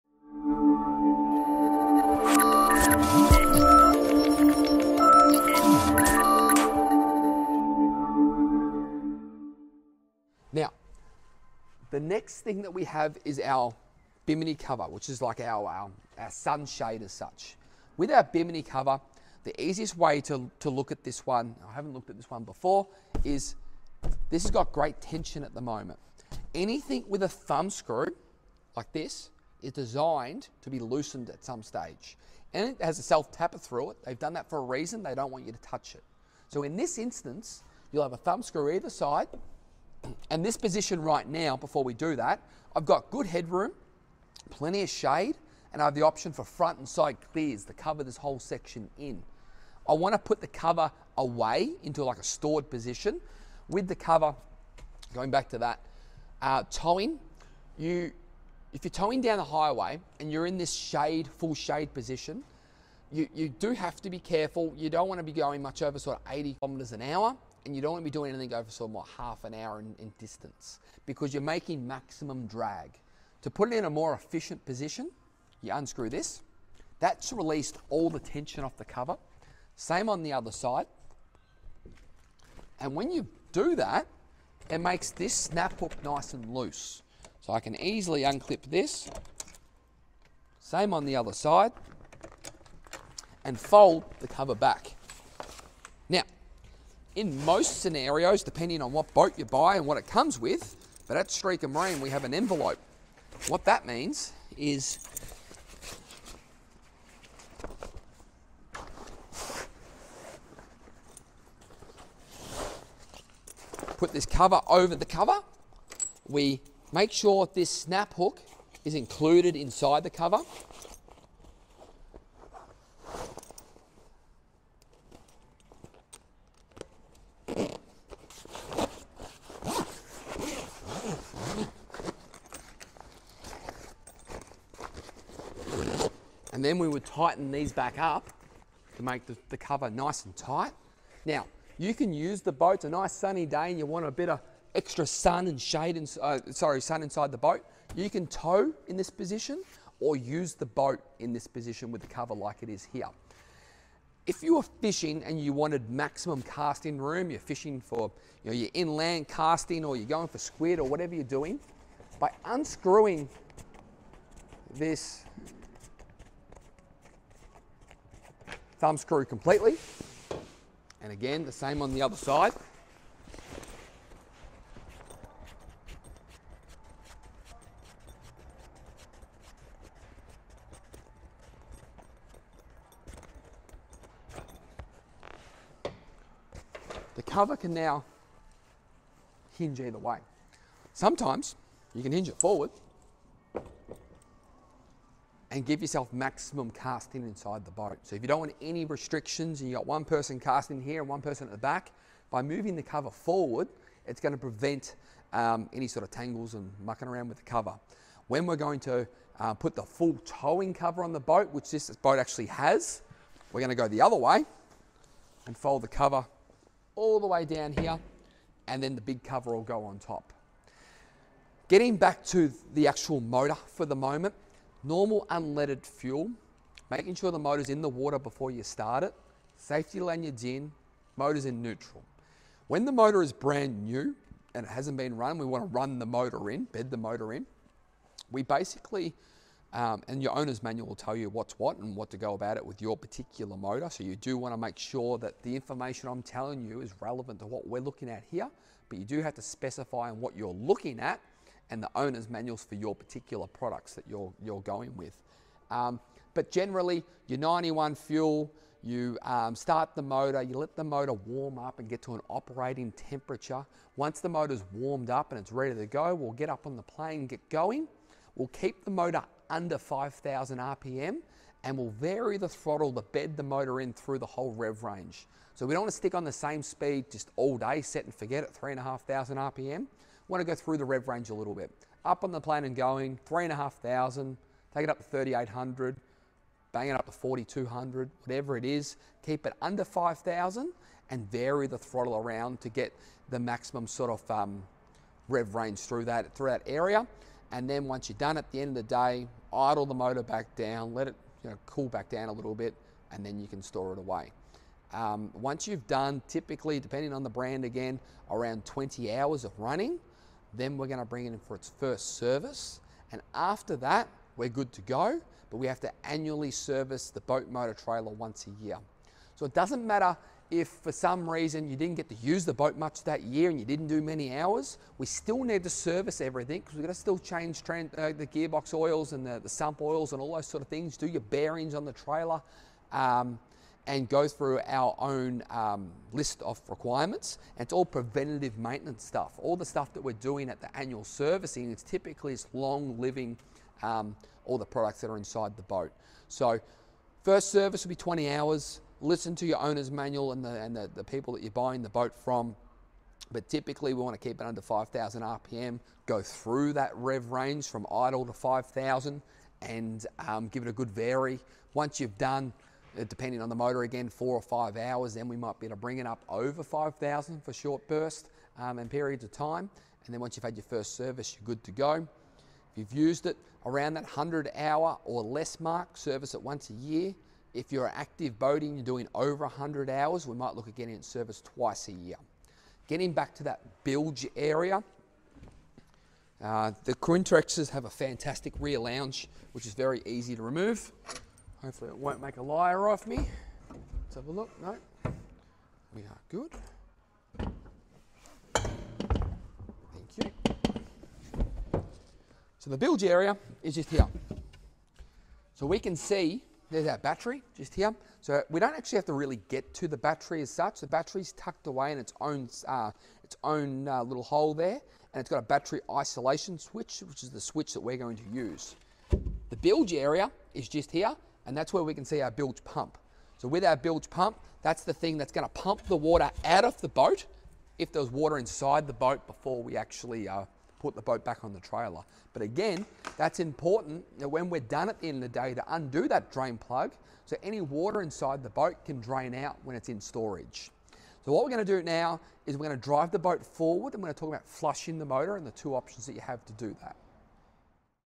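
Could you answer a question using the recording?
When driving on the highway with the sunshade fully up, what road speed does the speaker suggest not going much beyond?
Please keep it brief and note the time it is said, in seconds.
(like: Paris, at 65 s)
80 km/h, at 66 s.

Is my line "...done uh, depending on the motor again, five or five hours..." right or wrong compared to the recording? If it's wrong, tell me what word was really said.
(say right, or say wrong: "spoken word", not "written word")
wrong: "four", not "five".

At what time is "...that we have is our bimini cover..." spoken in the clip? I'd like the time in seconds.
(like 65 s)
12 s.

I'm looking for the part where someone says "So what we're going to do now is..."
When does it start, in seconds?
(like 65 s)
441 s.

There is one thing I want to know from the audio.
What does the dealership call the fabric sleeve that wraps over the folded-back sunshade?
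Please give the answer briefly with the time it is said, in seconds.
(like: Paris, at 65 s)
envelope, at 102 s.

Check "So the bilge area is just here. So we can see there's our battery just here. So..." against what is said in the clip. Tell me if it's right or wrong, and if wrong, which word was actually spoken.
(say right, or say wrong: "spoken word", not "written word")
right.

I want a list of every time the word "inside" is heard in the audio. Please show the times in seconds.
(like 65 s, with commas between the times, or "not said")
119 s, 147 s, 197 s, 345 s, 428 s, 438 s.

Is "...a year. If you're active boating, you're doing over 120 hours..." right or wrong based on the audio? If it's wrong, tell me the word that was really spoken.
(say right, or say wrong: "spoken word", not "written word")
wrong: "100", not "120".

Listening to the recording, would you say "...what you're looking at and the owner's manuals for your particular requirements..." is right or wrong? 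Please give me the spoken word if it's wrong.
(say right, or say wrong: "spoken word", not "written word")
wrong: "products", not "requirements".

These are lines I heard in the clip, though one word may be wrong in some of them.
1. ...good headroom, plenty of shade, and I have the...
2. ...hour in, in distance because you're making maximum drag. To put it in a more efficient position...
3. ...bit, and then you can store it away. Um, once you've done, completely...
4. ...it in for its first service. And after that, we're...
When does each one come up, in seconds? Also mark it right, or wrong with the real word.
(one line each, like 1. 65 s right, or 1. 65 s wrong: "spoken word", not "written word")
1. 43 s right
2. 69 s right
3. 302 s wrong: "typically", not "completely"
4. 311 s right.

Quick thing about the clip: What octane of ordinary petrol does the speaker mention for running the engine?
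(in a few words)
91.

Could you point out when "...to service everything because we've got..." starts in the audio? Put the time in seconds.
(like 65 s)
325 s.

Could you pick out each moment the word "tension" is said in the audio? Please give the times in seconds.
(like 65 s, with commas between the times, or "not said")
25 s, 78 s.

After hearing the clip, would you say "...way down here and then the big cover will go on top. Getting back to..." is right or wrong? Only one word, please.
right.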